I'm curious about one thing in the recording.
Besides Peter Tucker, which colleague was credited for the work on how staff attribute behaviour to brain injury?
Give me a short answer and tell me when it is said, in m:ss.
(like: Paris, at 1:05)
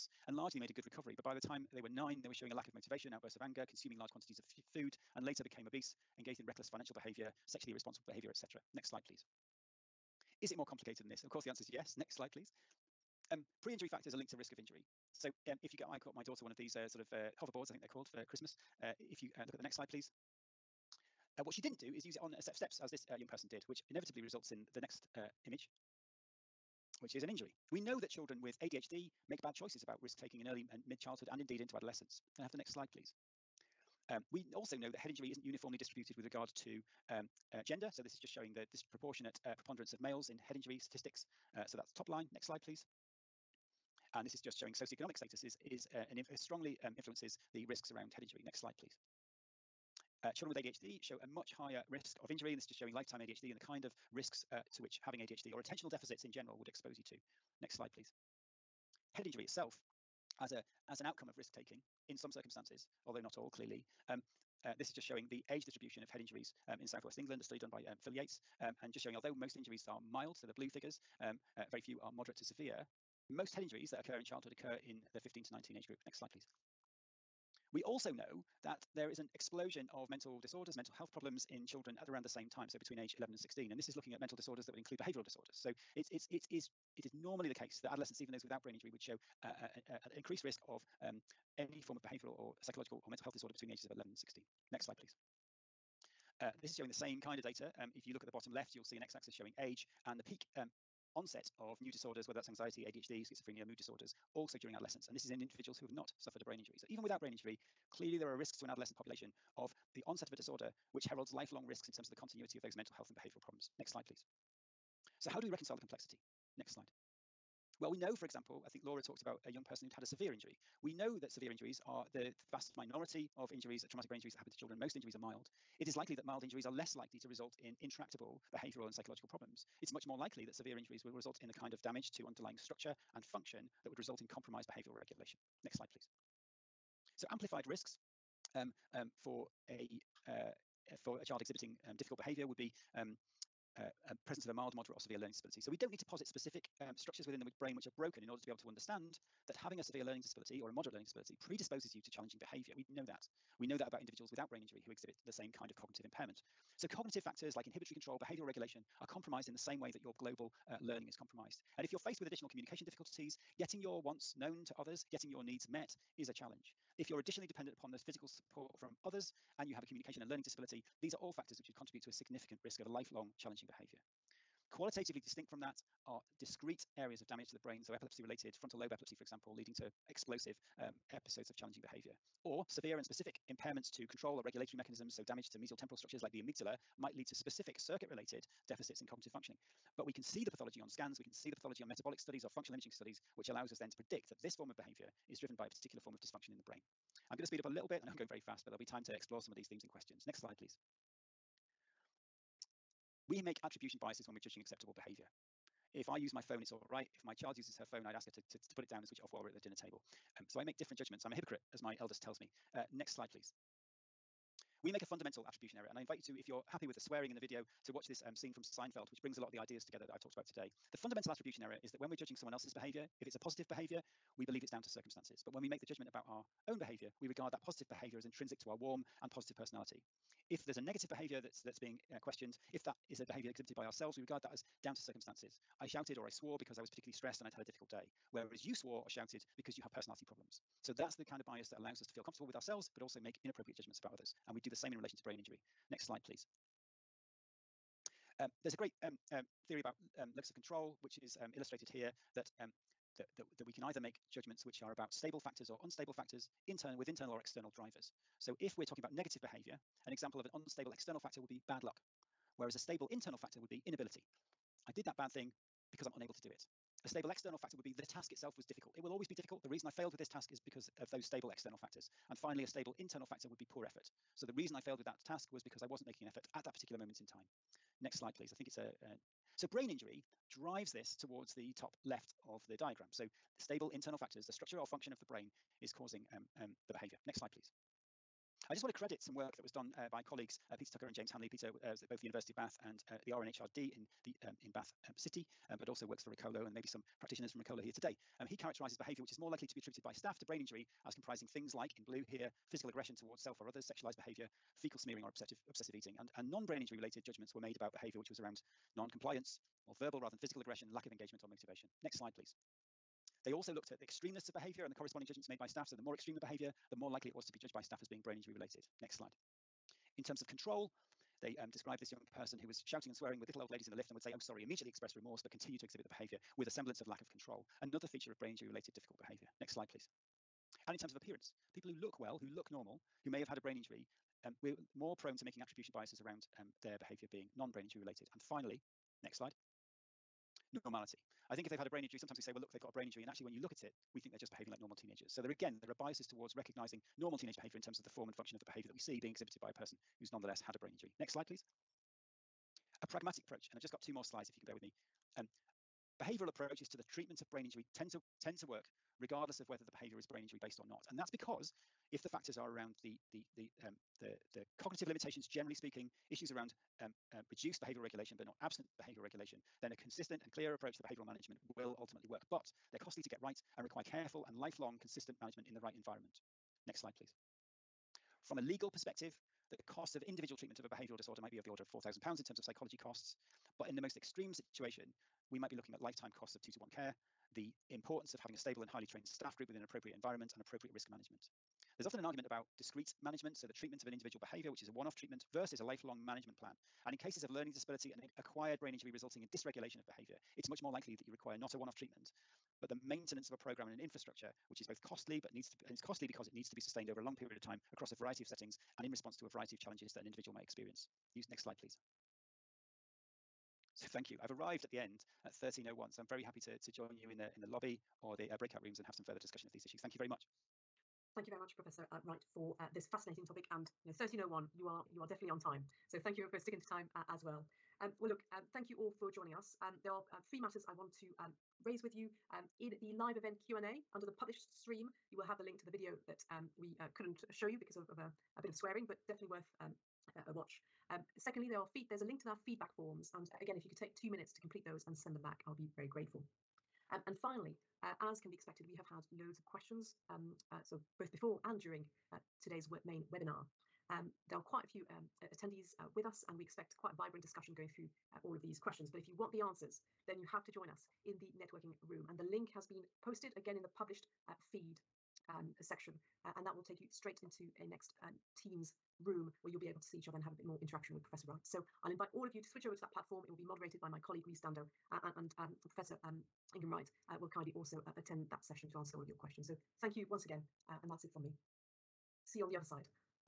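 James Hanley, at 4:51.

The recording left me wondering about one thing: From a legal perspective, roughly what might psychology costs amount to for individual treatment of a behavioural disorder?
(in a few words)
£4,000.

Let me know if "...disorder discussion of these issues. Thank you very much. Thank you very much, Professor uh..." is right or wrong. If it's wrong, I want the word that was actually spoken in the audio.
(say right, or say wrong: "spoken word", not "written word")
wrong: "further", not "disorder".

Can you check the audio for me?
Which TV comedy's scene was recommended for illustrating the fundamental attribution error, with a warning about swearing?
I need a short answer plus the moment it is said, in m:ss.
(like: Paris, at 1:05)
Seinfeld, at 3:38.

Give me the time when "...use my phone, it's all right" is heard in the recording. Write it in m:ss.
3:26.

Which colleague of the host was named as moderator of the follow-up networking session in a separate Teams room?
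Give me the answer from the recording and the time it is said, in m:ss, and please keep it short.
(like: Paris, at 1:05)
Rhys Dando, at 7:54.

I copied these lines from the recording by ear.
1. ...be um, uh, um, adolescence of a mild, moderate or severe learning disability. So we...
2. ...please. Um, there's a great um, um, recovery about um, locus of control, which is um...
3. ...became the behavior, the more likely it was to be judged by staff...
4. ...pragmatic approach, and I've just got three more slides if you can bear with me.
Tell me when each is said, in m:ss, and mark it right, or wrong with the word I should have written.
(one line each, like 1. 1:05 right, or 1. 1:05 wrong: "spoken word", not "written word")
1. 2:22 wrong: "presence", not "adolescence"
2. 4:06 wrong: "theory", not "recovery"
3. 5:16 wrong: "extreme", not "became"
4. 5:53 wrong: "two", not "three".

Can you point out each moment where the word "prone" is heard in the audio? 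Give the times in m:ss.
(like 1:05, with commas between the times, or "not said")
5:35.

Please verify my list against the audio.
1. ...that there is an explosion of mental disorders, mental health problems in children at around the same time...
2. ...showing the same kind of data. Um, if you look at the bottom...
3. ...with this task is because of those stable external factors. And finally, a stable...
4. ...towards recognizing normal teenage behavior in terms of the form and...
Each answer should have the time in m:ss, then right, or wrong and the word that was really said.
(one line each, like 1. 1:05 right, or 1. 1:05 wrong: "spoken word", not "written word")
1. 1:18 right
2. 1:36 right
3. 4:30 right
4. 5:46 right.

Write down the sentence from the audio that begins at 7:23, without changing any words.
And uh, again, if you could take two minutes to complete those and send them back, I'll be very grateful.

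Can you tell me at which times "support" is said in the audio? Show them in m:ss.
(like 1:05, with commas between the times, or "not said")
2:48.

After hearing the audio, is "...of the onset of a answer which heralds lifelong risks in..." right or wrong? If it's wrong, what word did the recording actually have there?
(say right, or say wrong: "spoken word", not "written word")
wrong: "disorder", not "answer".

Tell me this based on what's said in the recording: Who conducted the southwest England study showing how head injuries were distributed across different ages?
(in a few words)
Phil Yates.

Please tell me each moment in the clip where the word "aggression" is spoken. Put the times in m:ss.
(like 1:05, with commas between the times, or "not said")
5:02, 5:10.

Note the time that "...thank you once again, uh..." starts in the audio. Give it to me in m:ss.
7:59.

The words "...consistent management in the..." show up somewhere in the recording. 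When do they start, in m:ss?
6:14.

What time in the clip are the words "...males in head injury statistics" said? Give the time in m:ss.
0:39.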